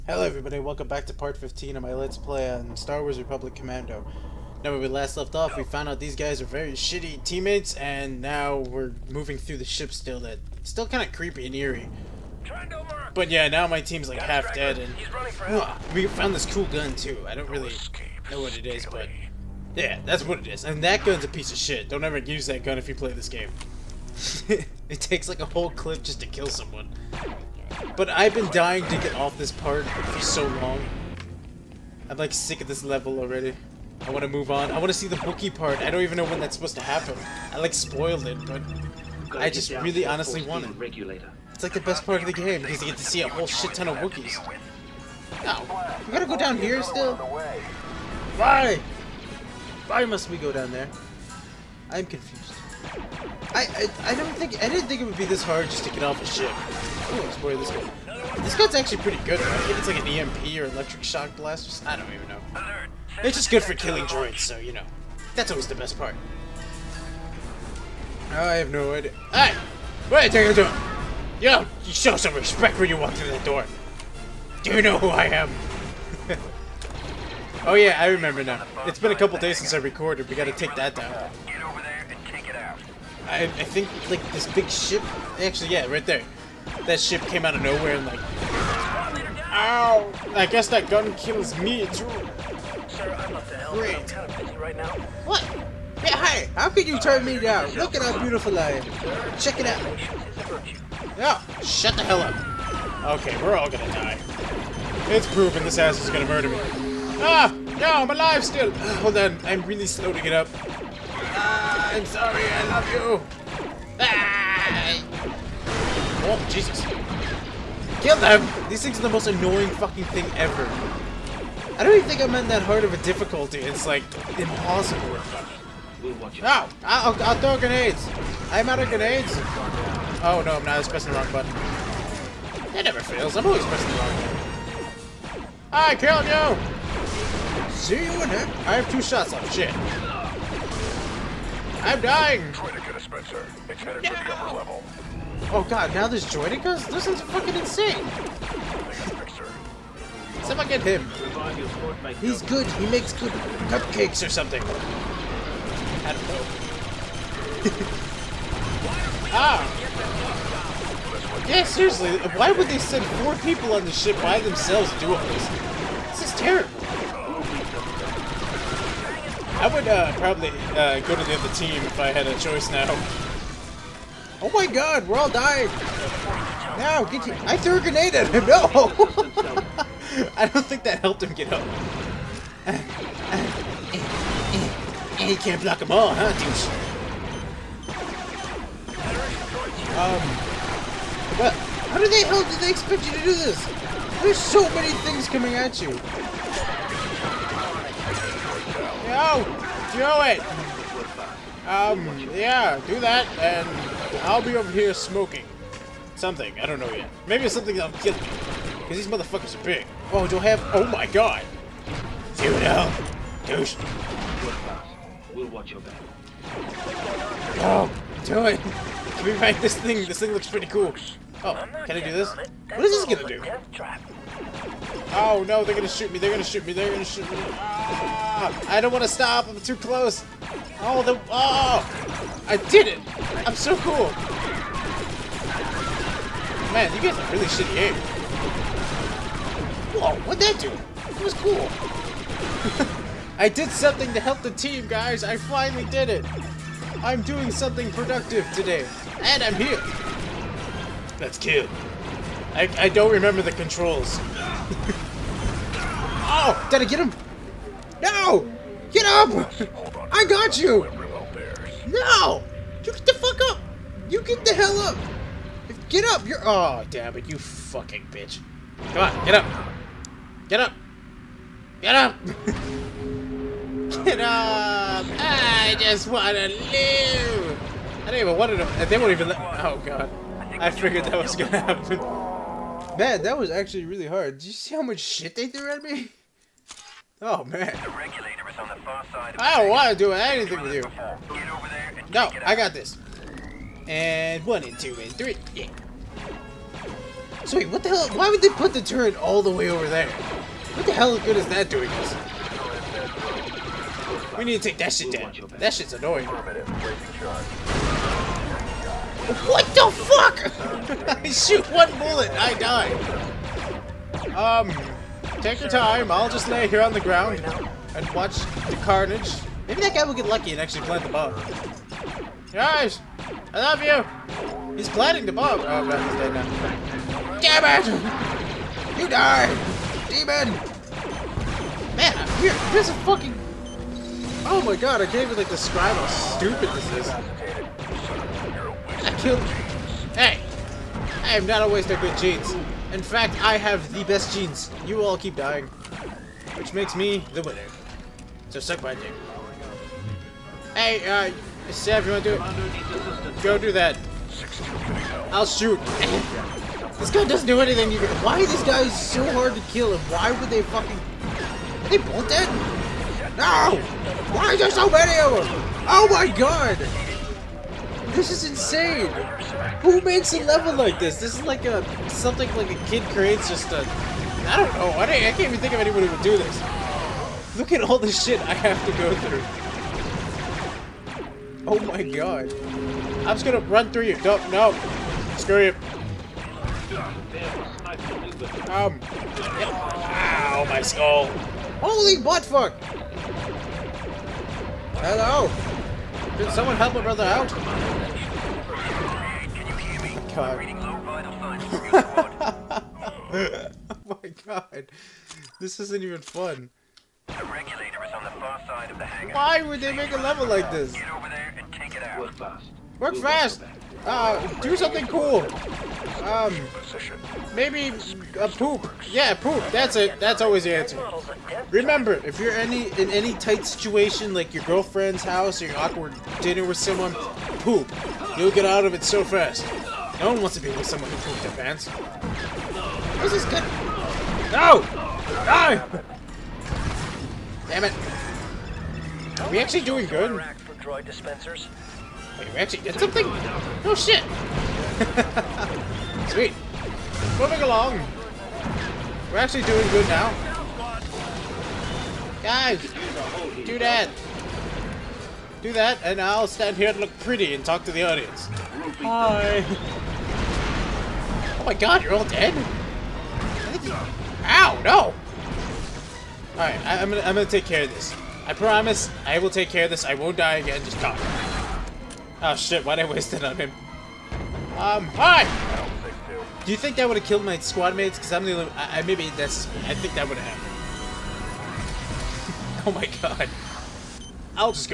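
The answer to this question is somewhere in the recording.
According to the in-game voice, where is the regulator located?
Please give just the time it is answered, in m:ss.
6:48.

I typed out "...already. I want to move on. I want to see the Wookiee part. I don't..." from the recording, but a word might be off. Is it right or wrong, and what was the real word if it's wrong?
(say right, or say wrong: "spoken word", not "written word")
right.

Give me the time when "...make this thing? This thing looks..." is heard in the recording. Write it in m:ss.
3:39.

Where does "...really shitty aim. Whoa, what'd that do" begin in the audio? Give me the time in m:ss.
3:57.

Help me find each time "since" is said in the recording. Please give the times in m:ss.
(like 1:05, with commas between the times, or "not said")
1:19.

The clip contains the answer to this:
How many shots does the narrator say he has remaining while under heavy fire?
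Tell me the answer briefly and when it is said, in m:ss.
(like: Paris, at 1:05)
2, at 2:18.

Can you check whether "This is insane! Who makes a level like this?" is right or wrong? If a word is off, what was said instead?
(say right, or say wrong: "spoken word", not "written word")
right.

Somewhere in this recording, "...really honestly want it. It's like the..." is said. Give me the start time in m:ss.
0:39.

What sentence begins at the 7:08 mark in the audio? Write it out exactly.
You'll get out of it so fast.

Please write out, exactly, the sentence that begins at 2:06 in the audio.
We'll watch Oh, I'll, I'll throw grenades.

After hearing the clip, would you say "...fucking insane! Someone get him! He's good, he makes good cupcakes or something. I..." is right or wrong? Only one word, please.
right.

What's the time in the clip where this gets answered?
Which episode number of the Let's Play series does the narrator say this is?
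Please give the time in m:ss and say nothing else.
0:01.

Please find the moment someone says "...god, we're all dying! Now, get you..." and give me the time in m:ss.
2:54.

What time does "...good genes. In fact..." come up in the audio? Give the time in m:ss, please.
5:41.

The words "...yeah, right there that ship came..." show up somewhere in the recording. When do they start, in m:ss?
1:25.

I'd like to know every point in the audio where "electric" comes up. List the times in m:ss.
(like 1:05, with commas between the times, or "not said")
1:00.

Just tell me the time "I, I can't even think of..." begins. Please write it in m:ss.
6:14.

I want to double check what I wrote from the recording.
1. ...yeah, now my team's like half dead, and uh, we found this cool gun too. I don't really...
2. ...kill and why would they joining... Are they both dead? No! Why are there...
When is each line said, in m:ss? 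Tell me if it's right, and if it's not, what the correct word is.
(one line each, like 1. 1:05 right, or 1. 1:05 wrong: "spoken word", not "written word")
1. 0:13 right
2. 5:59 wrong: "fucking", not "joining".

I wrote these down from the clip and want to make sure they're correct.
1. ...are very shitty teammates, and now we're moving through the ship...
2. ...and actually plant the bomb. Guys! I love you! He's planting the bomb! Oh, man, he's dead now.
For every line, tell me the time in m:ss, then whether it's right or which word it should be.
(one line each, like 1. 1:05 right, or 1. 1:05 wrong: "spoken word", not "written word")
1. 0:06 right
2. 5:20 right.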